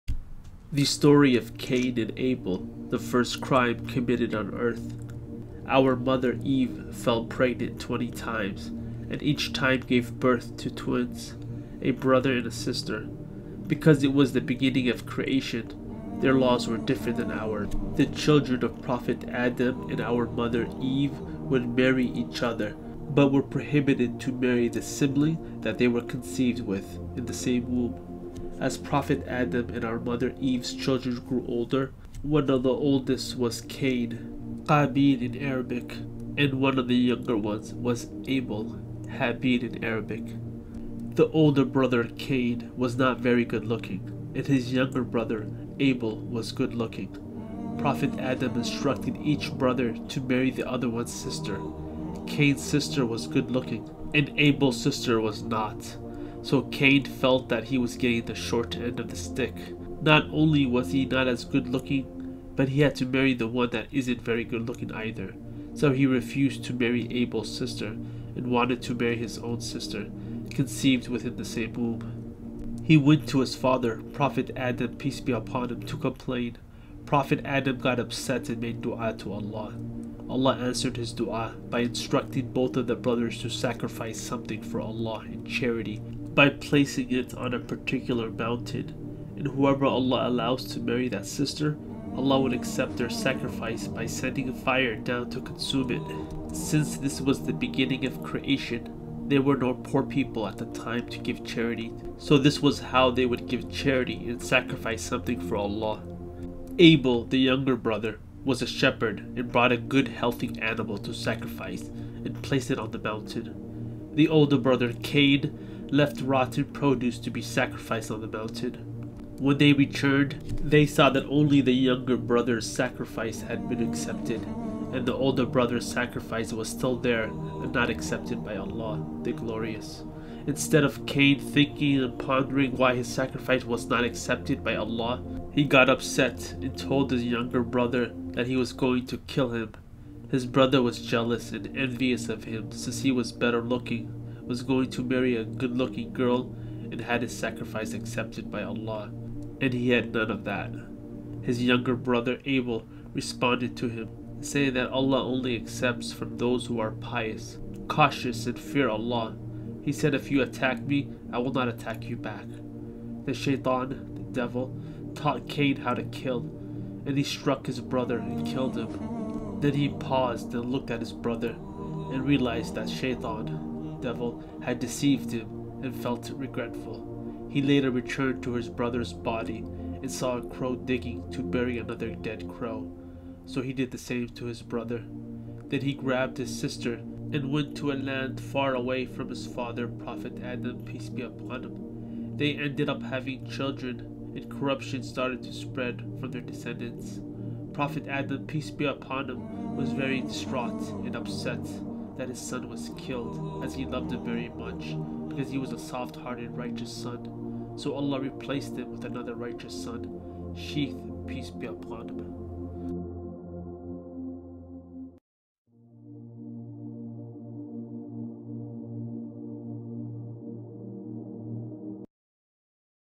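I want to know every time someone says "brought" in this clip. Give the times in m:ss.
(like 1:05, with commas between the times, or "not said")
1:49.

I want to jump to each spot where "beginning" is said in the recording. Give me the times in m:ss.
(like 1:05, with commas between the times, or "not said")
0:14, 1:37.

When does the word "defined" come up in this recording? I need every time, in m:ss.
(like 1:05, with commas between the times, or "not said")
not said.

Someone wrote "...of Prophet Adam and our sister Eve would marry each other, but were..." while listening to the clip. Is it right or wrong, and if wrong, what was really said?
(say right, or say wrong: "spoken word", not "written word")
wrong: "mother", not "sister".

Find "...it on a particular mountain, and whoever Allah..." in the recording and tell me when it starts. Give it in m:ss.
1:27.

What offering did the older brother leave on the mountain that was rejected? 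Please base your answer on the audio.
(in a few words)
Rotted produce.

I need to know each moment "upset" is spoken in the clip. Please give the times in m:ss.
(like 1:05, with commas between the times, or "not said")
1:17, 2:15, 3:21.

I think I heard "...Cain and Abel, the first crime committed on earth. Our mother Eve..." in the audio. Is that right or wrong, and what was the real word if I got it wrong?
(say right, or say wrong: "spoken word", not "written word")
right.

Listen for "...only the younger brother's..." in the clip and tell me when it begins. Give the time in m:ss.
2:01.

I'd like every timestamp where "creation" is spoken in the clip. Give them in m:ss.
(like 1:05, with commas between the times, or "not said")
0:15, 1:38.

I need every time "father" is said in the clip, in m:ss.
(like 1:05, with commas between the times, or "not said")
1:13, 3:09.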